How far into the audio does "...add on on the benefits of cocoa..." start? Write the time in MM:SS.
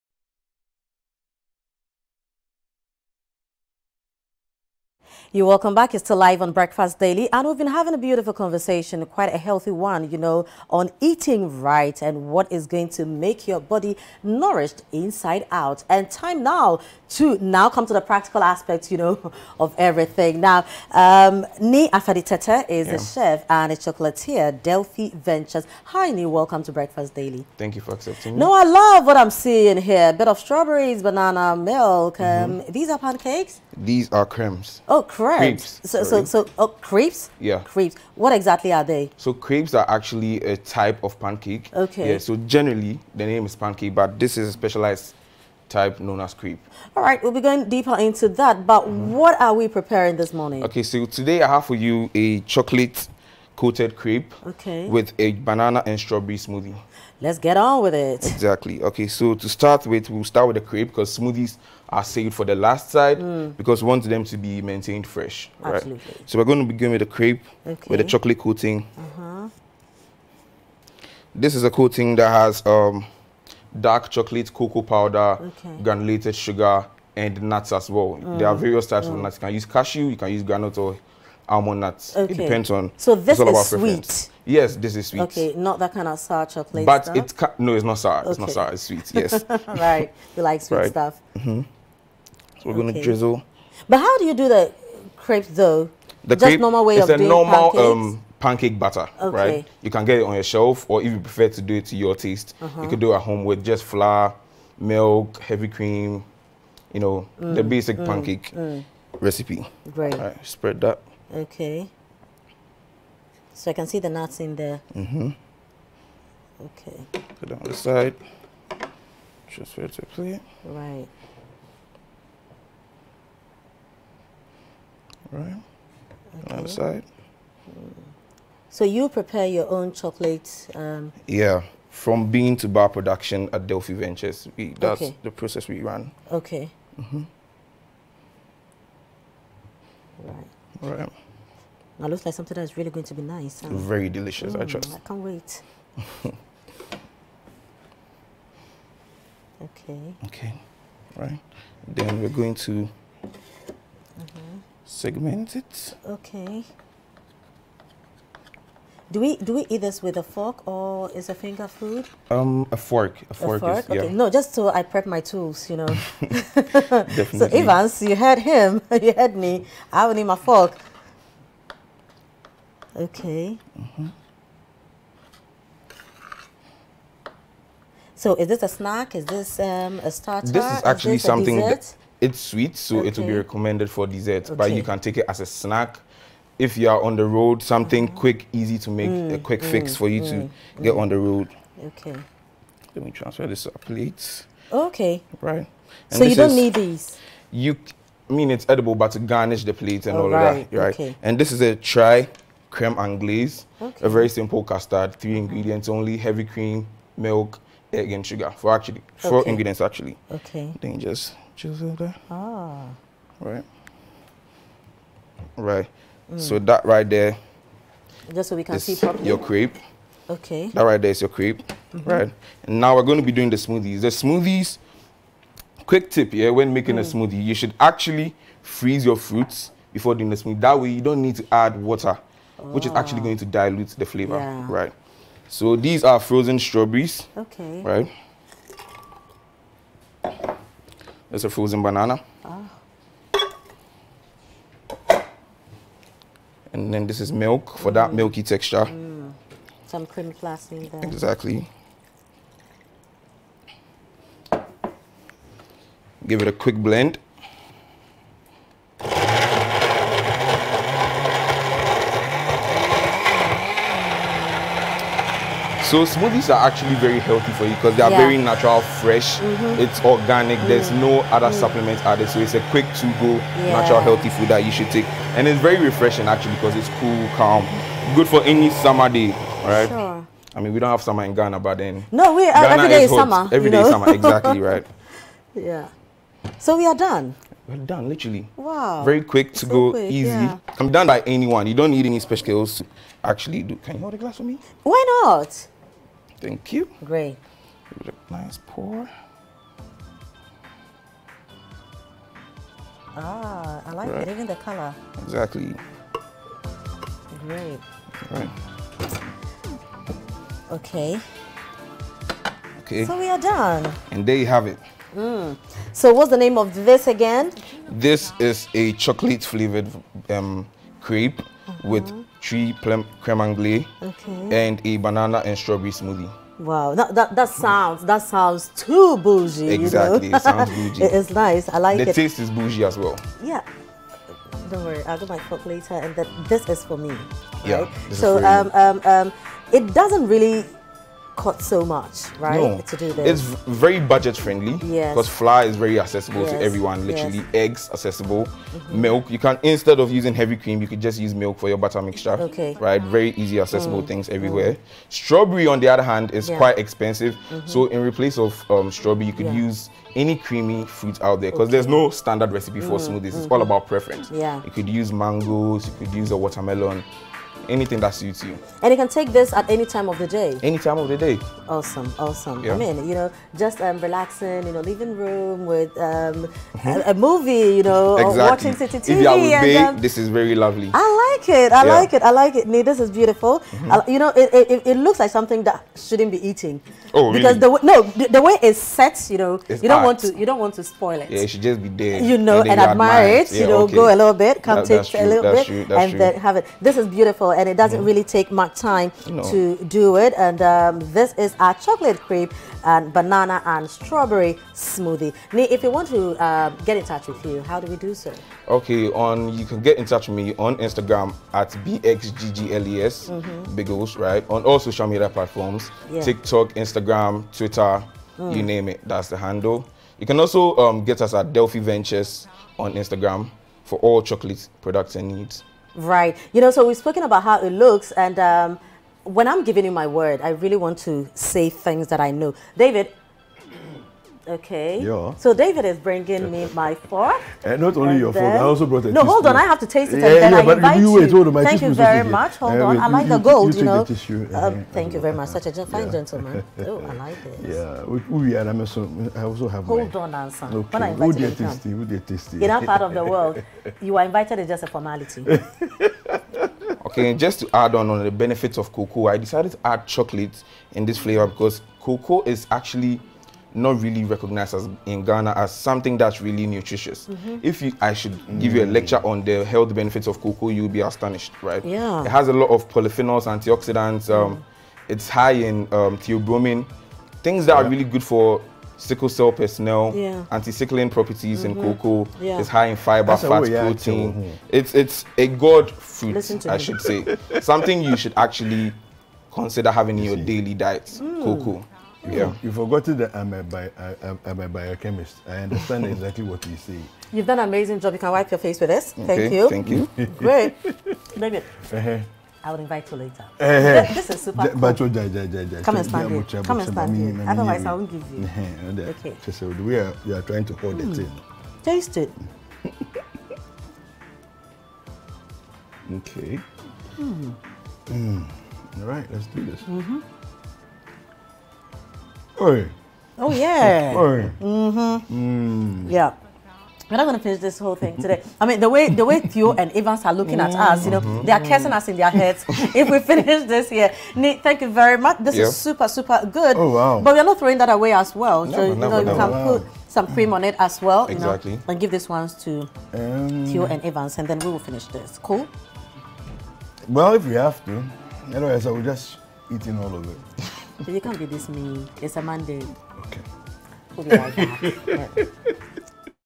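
07:37.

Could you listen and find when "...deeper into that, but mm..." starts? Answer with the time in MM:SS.
00:47.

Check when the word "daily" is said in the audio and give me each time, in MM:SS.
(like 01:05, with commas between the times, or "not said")
00:06, 00:27, 08:10.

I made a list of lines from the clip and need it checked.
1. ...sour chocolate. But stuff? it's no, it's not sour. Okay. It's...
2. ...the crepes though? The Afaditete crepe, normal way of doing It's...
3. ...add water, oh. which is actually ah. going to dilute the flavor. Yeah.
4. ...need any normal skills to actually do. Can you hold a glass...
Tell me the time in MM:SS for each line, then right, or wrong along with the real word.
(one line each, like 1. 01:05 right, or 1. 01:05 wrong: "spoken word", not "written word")
1. 01:26 right
2. 01:34 wrong: "Just", not "Afaditete"
3. 03:51 right
4. 04:51 wrong: "special", not "normal".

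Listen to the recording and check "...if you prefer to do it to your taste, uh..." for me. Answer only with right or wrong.
right.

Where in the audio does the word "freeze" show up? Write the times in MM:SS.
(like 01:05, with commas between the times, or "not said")
03:48.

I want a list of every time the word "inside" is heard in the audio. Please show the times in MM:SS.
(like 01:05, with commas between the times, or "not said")
00:14.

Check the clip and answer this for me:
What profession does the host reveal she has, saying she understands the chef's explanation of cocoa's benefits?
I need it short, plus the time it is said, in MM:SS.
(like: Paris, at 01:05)
Biochemist, at 08:14.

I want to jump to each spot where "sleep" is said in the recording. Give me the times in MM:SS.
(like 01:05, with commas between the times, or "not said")
not said.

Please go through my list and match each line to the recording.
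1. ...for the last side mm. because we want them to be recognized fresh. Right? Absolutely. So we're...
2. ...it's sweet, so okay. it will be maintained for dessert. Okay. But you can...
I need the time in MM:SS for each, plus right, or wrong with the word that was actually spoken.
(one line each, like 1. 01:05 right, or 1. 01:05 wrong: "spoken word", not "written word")
1. 01:02 wrong: "maintained", not "recognized"
2. 03:02 wrong: "recommended", not "maintained".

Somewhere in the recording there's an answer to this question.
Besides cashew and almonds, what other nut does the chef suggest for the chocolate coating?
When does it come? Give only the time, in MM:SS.
01:20.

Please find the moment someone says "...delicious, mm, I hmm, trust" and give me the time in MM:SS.
02:24.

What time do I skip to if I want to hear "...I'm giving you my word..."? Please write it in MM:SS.
07:09.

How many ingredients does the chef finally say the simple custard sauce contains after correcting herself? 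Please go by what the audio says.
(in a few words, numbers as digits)
4.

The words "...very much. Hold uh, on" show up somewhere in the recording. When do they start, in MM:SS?
07:21.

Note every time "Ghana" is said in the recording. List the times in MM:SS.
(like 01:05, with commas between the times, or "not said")
04:41, 07:45.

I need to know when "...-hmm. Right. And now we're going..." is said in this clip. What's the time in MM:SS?
03:42.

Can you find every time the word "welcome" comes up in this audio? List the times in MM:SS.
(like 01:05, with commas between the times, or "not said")
00:05, 00:26.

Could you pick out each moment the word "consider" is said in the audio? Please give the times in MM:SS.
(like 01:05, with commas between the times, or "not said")
08:09.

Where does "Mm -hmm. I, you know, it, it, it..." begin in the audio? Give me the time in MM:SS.
06:23.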